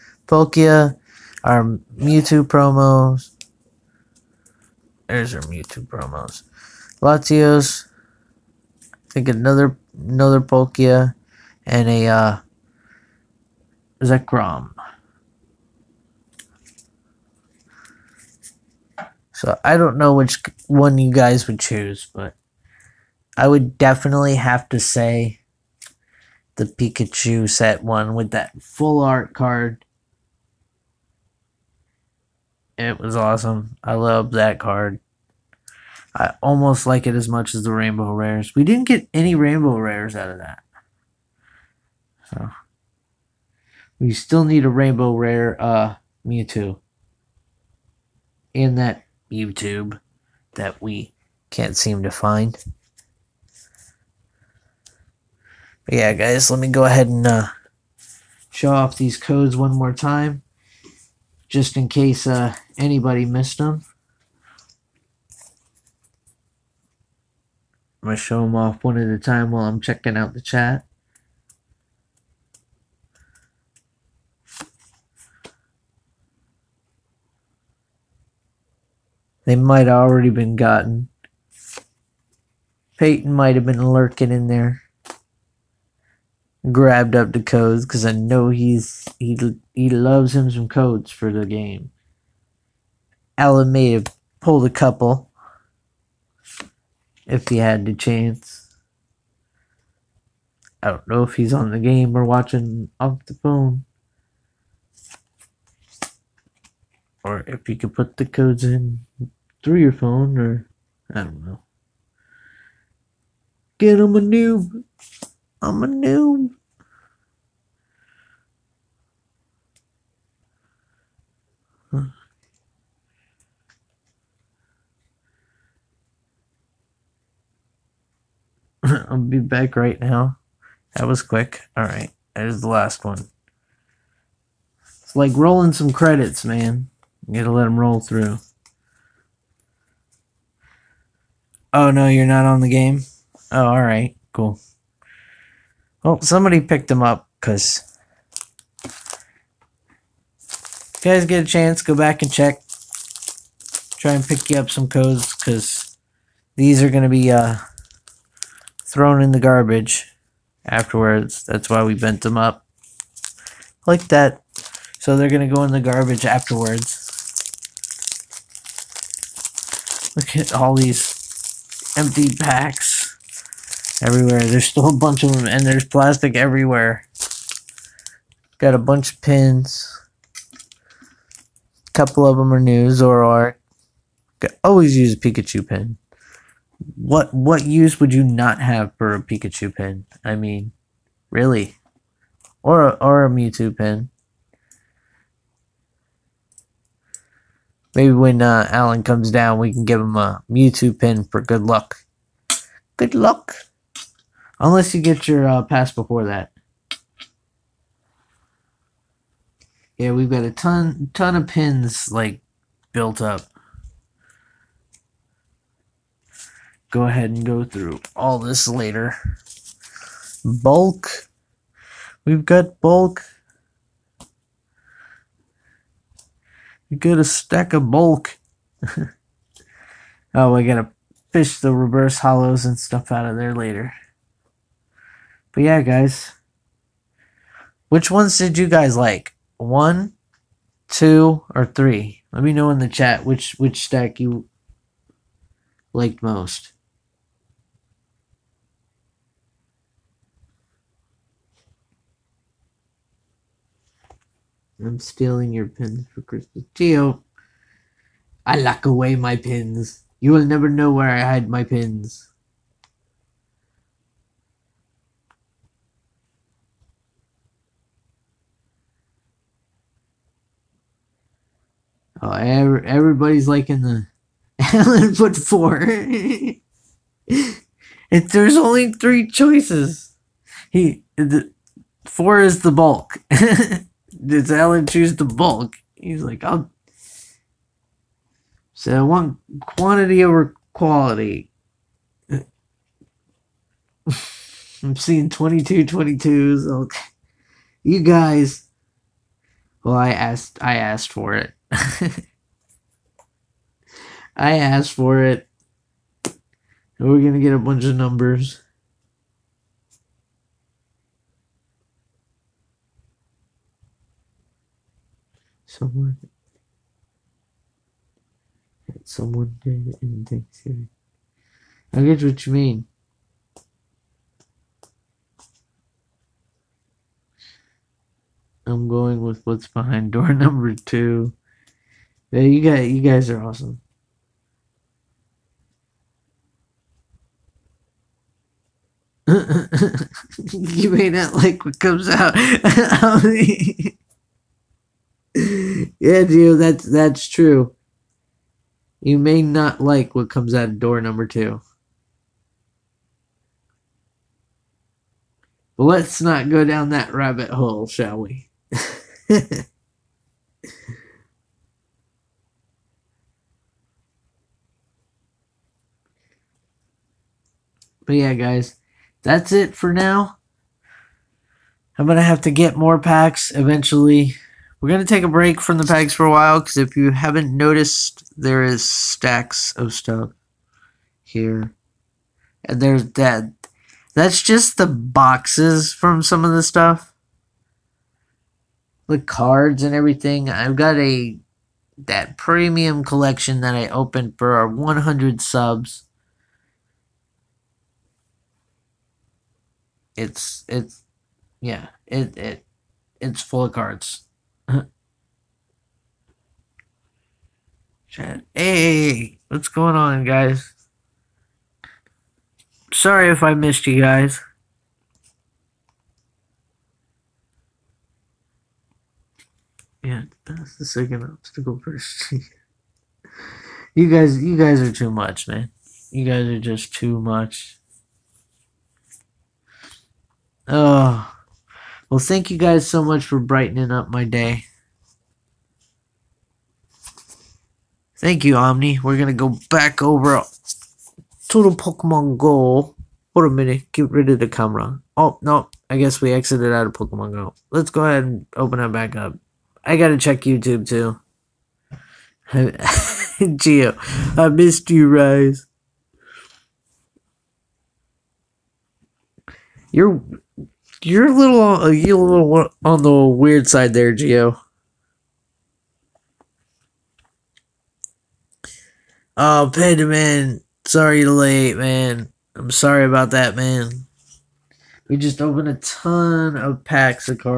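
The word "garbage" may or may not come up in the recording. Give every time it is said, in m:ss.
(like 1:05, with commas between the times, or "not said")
2:39, 2:45.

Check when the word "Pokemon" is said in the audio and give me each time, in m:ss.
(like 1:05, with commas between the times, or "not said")
7:21, 7:26.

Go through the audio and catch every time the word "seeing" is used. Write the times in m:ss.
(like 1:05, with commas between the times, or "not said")
4:54.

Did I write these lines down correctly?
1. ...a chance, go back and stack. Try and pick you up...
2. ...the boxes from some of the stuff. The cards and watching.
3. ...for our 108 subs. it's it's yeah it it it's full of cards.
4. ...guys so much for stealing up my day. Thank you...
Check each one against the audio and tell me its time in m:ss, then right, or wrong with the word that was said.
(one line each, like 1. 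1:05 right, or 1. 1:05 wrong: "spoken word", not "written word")
1. 2:31 wrong: "check", not "stack"
2. 6:24 wrong: "everything", not "watching"
3. 6:34 wrong: "100", not "108"
4. 7:12 wrong: "brightening", not "stealing".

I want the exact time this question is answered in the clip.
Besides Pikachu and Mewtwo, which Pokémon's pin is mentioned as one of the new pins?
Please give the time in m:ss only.
3:02.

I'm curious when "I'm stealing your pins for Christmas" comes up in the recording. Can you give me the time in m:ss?
4:14.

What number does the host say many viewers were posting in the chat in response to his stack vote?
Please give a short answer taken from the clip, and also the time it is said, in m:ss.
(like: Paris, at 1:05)
22, at 4:55.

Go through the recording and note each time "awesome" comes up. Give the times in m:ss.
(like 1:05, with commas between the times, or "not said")
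0:33, 5:33.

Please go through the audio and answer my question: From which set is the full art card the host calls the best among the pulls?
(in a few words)
Pikachu set.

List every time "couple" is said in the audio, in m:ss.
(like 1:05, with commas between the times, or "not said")
1:34, 3:01.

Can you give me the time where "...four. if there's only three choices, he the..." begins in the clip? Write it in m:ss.
4:35.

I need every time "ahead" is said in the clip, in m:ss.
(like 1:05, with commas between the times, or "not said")
0:56, 3:37, 7:28.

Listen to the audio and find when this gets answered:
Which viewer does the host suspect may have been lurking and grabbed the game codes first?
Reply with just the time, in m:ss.
1:22.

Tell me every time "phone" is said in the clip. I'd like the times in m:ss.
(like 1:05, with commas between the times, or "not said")
1:43, 1:49.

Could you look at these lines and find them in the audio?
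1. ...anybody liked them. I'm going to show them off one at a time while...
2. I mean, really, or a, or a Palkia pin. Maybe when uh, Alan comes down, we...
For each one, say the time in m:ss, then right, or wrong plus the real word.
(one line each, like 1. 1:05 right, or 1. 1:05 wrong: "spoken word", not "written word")
1. 1:02 wrong: "missed", not "liked"
2. 3:10 wrong: "Mewtwo", not "Palkia".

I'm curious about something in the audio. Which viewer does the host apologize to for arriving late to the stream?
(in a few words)
Panda Man.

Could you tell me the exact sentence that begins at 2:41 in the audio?
That's why we bent them up like that.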